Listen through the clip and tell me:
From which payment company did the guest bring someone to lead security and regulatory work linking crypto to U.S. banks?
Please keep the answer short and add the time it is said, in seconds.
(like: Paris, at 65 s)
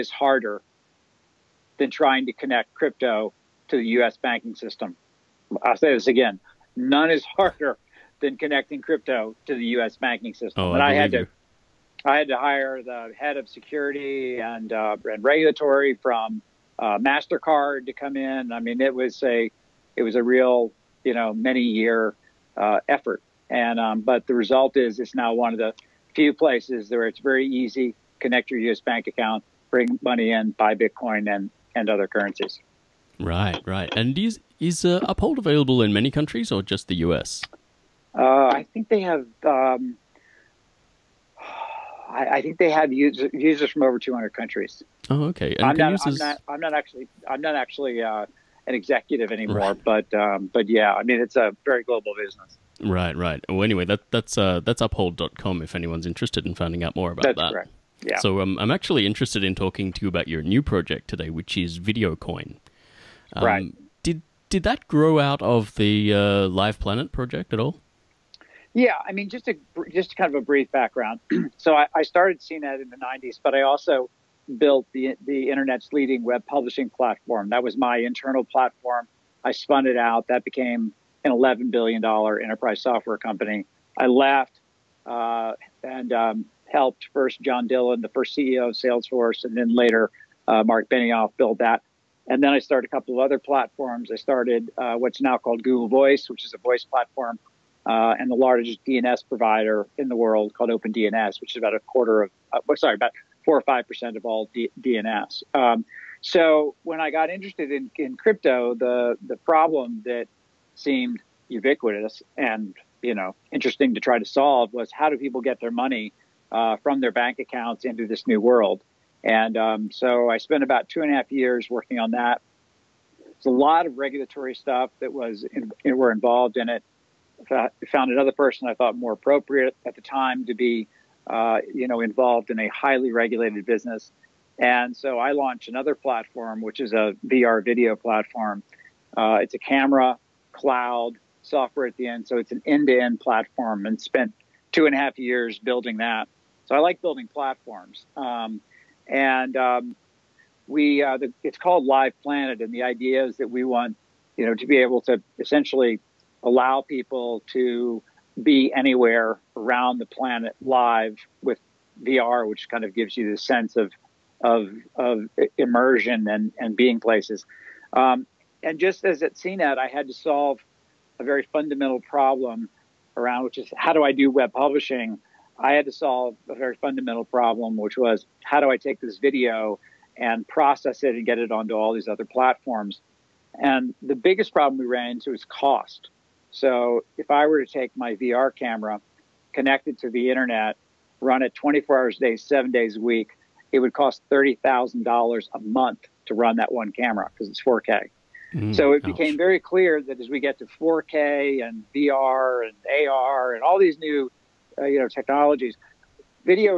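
Mastercard, at 16 s.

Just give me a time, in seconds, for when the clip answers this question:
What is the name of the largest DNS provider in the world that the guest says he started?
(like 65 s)
100 s.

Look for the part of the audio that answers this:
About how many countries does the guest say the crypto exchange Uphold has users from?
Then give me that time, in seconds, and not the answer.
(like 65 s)
43 s.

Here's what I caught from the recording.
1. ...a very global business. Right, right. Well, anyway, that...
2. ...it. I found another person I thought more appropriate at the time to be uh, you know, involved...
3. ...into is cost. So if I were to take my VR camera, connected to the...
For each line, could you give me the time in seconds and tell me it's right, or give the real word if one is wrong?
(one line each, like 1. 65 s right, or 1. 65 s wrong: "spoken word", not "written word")
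1. 51 s right
2. 126 s right
3. 185 s right.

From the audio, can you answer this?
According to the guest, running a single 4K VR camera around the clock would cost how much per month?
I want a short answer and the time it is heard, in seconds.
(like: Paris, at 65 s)
$30,000, at 194 s.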